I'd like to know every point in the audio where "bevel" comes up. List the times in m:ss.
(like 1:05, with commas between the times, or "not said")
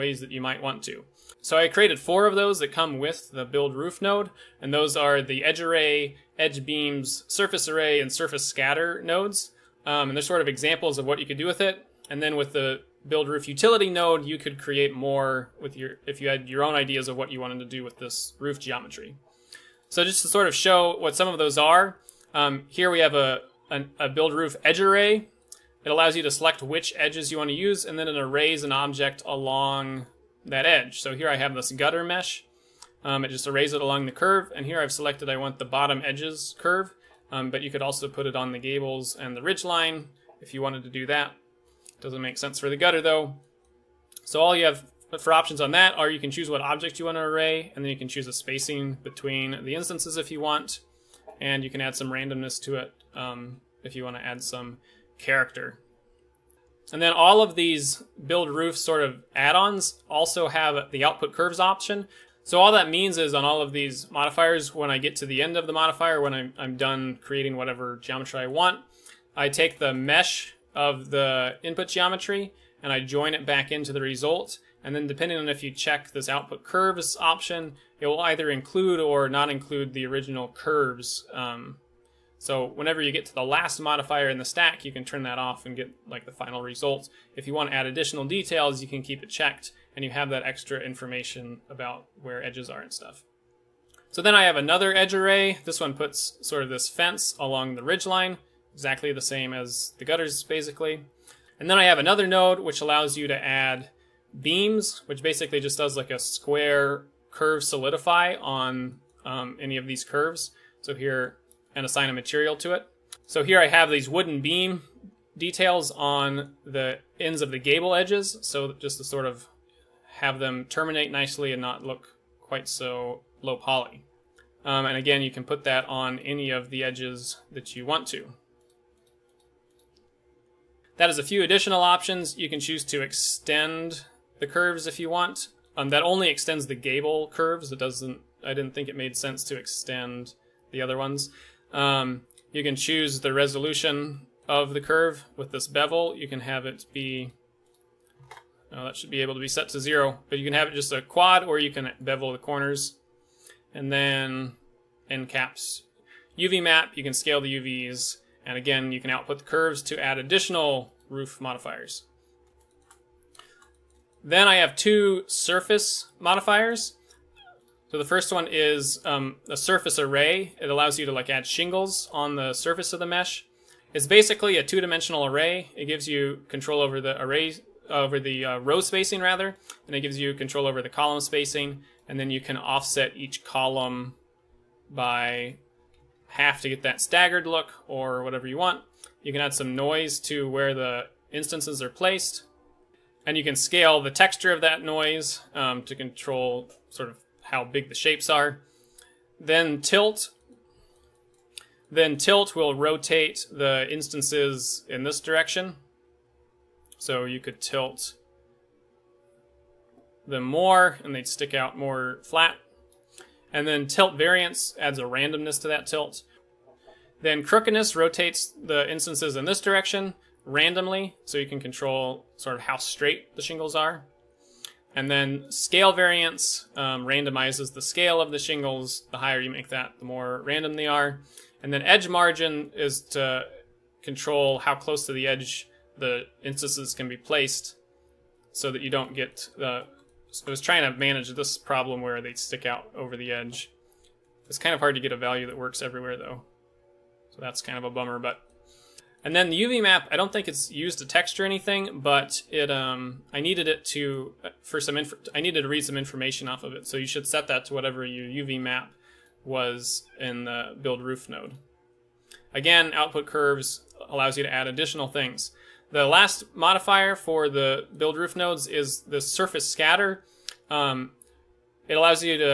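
2:25, 2:31.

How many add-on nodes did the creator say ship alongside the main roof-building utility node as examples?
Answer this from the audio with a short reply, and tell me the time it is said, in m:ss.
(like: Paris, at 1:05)
4, at 0:01.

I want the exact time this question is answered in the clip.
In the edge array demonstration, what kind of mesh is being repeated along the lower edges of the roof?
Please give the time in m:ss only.
0:31.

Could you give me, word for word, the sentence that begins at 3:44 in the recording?
And then scale variance um, randomizes the scale of the shingles.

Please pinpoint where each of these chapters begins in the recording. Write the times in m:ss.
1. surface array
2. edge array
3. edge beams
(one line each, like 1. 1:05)
1. 2:42
2. 0:19
3. 1:41.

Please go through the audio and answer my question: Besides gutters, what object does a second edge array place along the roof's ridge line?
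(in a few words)
Fence.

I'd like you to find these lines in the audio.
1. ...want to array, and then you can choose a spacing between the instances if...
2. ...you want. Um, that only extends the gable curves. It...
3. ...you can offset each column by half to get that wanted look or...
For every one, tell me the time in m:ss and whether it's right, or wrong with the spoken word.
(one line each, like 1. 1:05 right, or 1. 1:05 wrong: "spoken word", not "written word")
1. 0:47 right
2. 2:14 right
3. 3:02 wrong: "staggered", not "wanted".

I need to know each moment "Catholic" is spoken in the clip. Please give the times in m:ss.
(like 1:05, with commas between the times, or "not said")
not said.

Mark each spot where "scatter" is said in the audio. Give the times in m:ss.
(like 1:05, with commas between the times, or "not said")
0:08, 4:29.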